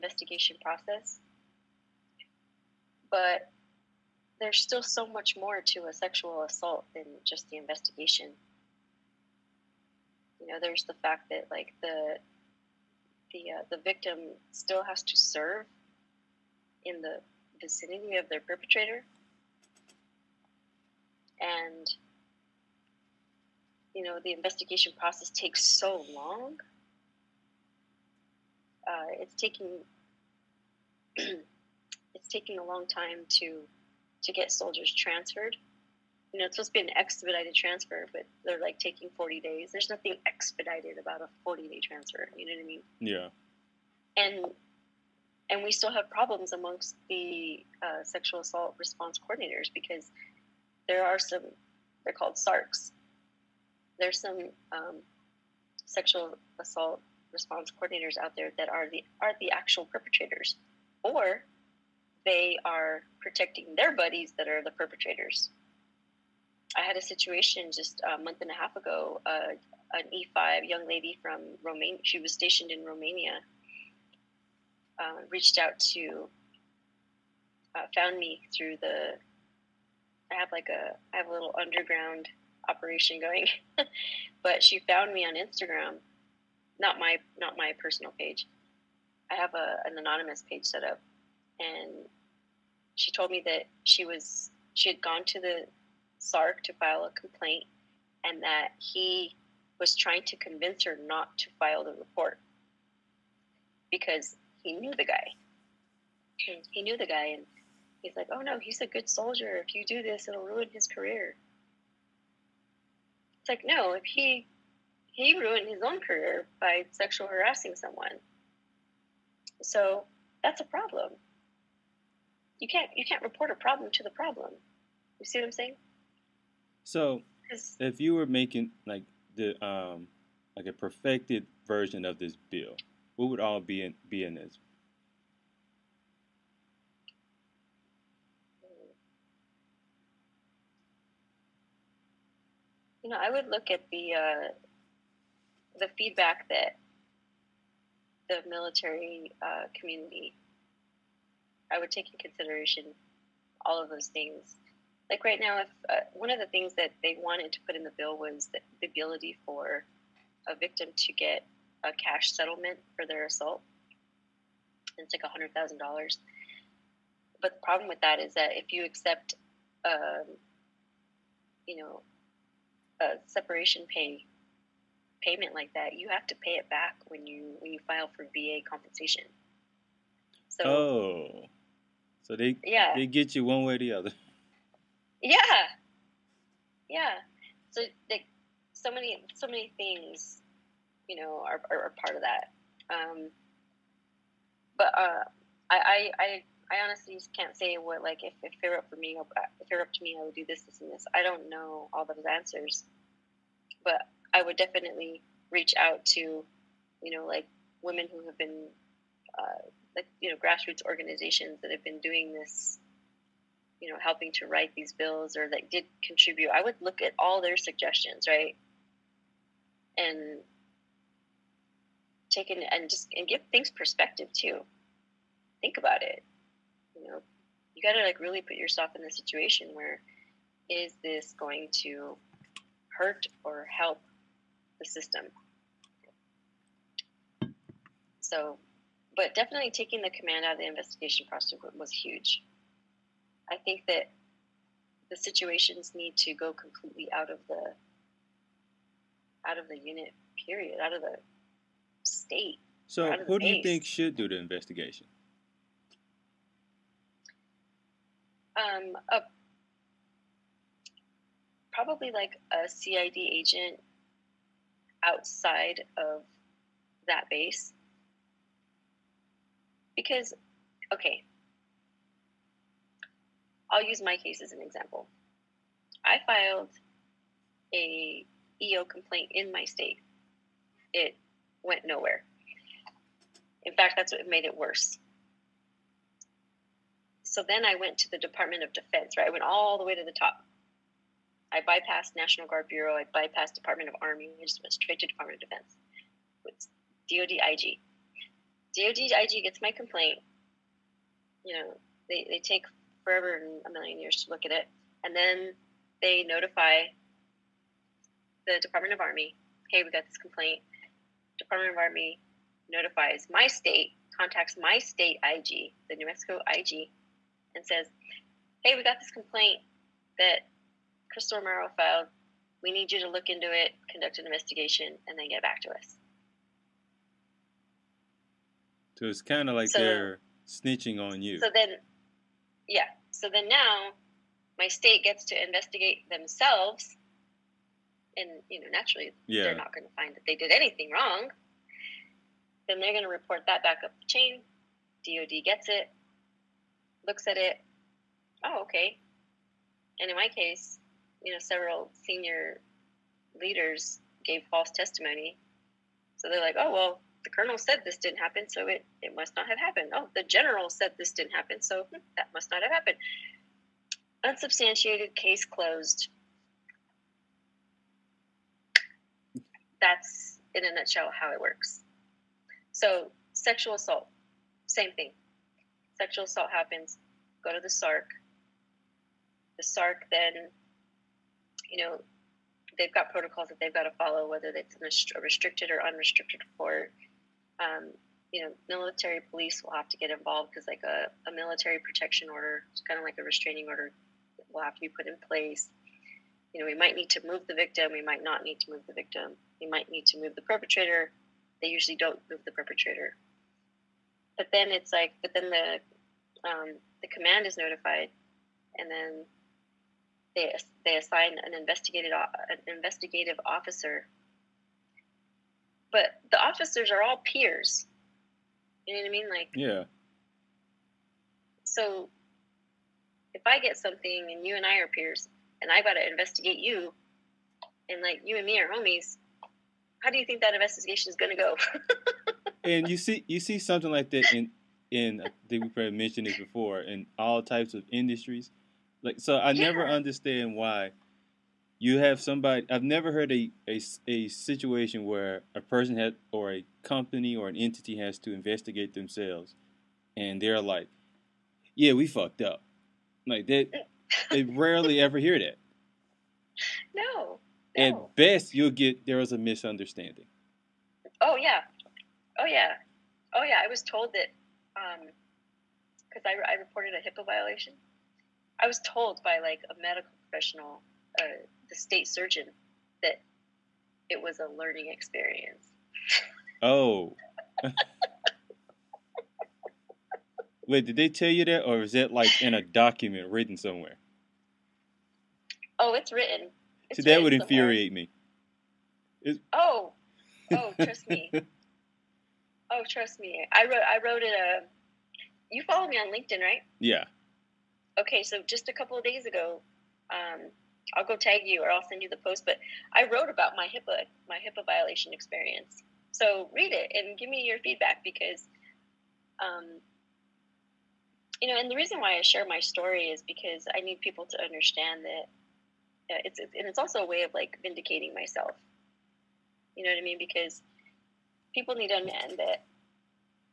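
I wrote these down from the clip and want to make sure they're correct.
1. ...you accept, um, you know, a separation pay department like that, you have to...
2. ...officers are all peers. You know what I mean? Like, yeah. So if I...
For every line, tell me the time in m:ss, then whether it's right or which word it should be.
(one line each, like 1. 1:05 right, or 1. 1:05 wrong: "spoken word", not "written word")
1. 2:48 wrong: "payment", not "department"
2. 6:56 right.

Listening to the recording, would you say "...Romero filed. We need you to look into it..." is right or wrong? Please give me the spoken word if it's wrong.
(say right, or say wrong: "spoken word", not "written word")
right.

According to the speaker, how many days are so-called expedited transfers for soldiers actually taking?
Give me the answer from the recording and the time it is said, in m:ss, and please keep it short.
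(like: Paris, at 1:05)
40, at 0:39.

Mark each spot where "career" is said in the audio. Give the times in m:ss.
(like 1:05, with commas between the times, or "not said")
1:50, 1:55.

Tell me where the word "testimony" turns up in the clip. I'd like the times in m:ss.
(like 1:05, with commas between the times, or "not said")
5:54.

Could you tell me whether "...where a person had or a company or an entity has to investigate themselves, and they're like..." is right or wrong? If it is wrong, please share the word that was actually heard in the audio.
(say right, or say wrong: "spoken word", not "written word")
right.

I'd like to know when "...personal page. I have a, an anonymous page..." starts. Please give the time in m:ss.
1:27.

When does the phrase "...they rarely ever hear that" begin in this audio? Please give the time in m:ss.
7:34.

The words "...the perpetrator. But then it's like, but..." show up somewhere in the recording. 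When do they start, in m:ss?
6:42.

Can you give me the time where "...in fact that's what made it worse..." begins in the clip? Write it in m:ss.
4:43.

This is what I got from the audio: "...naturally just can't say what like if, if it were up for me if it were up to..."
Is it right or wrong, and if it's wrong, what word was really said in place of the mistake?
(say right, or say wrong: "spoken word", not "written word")
wrong: "honestly", not "naturally".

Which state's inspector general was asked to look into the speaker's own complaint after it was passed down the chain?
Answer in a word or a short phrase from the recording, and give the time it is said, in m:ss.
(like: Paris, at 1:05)
New Mexico, at 5:15.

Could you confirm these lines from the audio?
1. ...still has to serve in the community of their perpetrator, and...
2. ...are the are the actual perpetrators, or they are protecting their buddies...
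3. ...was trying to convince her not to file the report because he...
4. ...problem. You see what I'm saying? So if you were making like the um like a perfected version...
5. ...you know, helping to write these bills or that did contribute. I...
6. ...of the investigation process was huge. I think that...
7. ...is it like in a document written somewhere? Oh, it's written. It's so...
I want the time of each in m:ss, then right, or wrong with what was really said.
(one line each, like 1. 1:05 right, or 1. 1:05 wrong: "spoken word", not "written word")
1. 0:14 wrong: "vicinity", not "community"
2. 0:58 right
3. 1:39 right
4. 2:04 right
5. 3:33 right
6. 4:00 right
7. 8:01 right.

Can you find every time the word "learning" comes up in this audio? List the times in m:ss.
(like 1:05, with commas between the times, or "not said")
7:54.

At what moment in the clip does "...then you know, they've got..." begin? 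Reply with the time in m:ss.
6:20.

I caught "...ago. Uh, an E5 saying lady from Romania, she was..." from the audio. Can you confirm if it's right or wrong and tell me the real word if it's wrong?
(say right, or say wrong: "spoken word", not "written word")
wrong: "young", not "saying".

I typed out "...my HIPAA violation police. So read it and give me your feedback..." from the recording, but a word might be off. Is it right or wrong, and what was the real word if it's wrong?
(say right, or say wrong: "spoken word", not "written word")
wrong: "experience", not "police".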